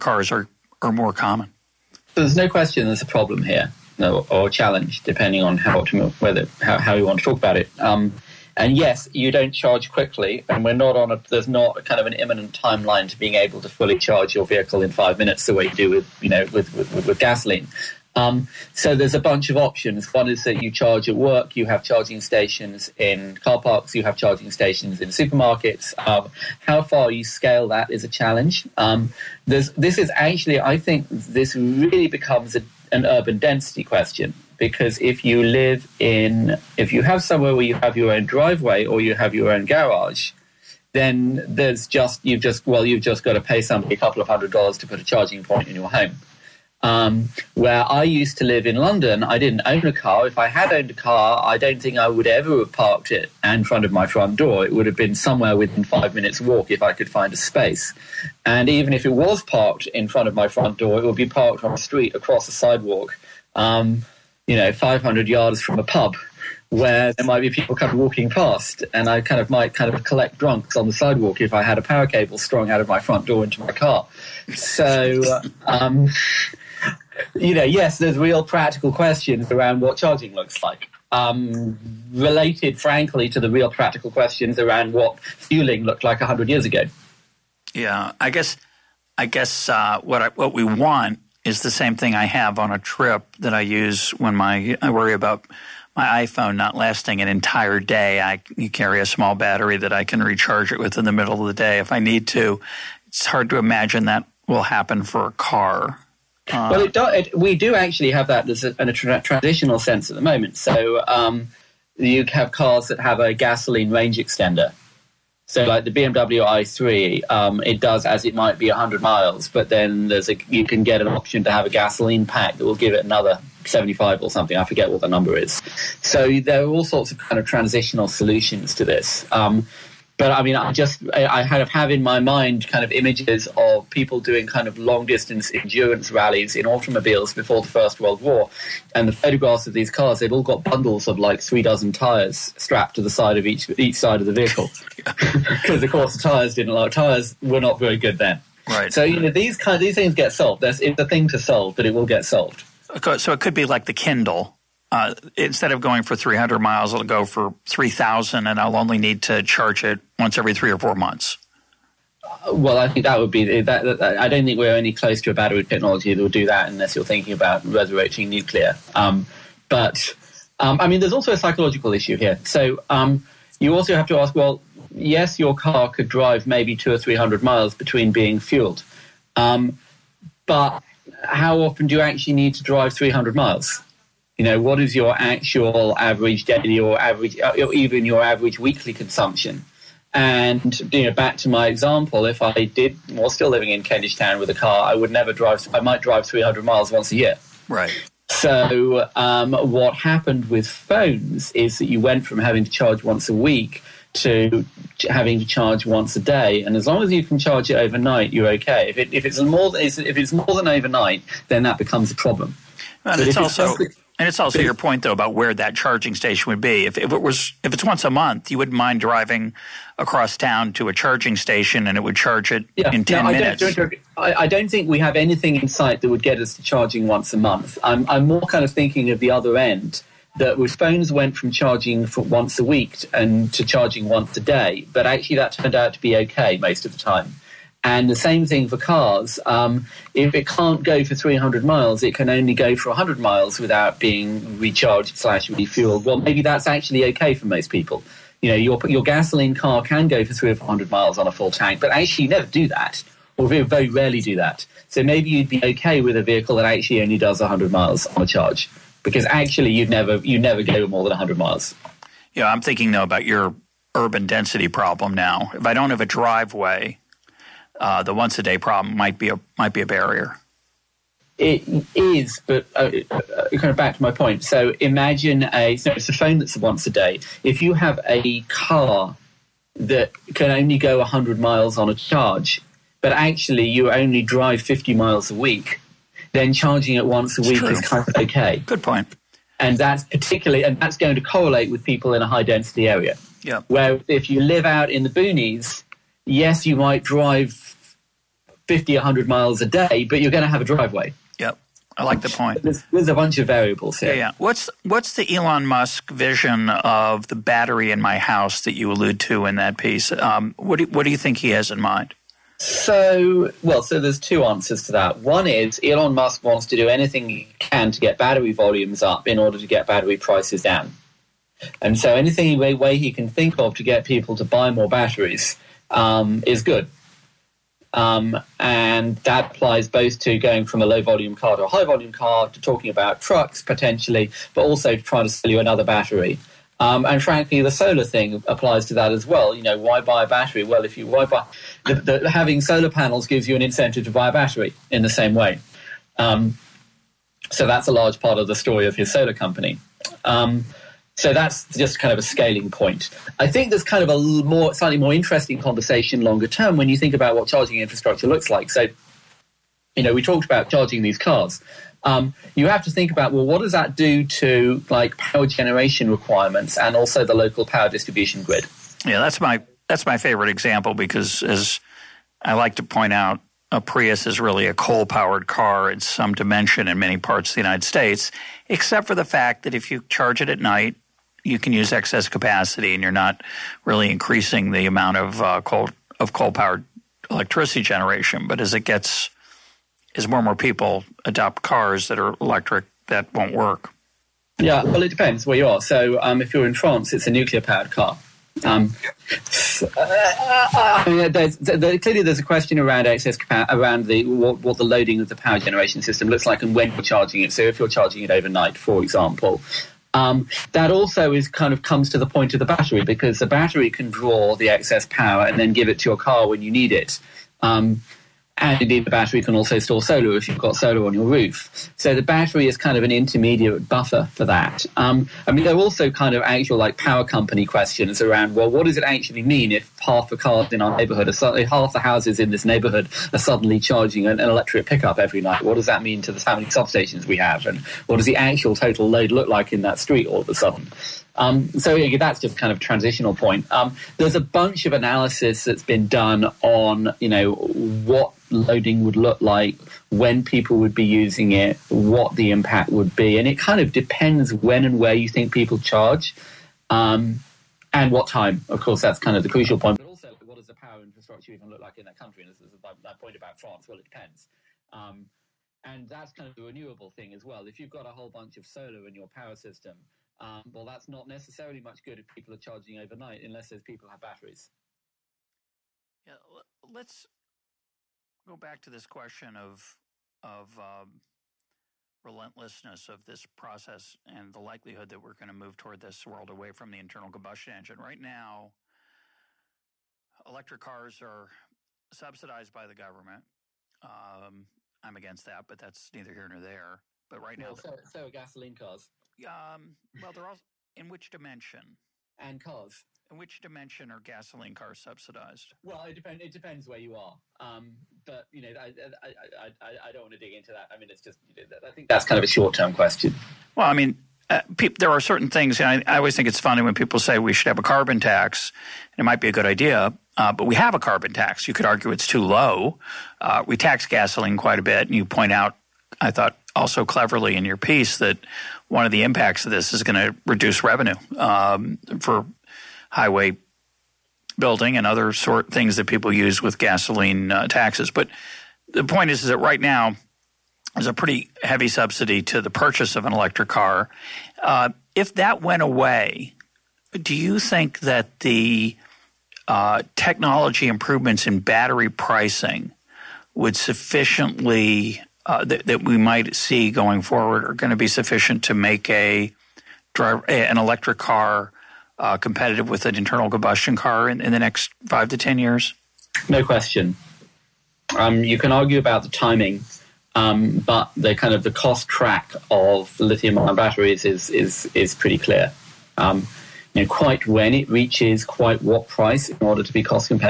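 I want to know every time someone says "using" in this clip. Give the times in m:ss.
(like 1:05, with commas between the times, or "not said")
7:31.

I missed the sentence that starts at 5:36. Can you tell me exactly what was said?
Um, and frankly, the solar thing applies to that as well.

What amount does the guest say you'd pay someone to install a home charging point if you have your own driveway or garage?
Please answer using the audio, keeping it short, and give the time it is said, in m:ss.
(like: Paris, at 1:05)
a couple of hundred dollars, at 0:43.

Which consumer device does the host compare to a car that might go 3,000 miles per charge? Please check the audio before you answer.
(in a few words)
Kindle.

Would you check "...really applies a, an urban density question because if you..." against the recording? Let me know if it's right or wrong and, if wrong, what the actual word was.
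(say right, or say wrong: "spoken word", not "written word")
wrong: "becomes", not "applies".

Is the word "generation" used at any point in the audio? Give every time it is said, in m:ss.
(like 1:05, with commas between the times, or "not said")
6:05, 6:27, 6:45.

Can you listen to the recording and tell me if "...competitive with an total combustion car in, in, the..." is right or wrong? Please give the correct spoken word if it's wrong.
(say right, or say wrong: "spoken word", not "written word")
wrong: "internal", not "total".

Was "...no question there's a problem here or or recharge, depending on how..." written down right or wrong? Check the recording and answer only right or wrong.
wrong.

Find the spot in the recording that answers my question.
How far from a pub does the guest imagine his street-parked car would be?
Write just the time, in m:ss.
1:04.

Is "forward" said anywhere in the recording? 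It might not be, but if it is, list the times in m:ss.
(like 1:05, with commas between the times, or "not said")
9:17.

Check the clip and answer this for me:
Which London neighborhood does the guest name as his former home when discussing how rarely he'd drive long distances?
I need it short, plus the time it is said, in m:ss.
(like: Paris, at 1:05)
Kentish Town, at 3:13.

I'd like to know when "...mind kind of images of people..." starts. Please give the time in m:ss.
2:12.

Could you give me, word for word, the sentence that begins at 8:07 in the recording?
Right now, electric cars are subsidized by the government.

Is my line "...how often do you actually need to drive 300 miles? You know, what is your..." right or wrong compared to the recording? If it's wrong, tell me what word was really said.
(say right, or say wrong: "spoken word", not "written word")
right.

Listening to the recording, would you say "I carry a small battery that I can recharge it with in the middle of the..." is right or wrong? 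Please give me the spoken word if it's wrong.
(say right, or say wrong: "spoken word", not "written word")
right.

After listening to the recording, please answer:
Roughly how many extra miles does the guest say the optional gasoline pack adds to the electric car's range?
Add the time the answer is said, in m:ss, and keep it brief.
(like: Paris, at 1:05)
75, at 2:03.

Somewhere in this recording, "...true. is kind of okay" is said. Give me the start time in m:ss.
4:47.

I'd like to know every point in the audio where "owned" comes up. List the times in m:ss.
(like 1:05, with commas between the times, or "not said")
0:50.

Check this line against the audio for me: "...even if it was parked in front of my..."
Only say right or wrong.
right.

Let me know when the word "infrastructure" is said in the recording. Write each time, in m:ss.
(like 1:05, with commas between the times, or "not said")
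5:57, 7:41.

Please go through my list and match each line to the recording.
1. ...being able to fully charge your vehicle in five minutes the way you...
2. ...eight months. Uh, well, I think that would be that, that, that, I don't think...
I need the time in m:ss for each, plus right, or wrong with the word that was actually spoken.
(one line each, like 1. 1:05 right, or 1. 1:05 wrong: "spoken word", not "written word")
1. 0:13 right
2. 2:40 wrong: "four", not "eight".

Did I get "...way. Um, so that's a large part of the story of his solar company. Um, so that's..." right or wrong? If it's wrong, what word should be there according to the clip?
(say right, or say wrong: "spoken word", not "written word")
right.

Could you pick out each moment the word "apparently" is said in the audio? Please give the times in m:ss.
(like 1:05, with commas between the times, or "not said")
not said.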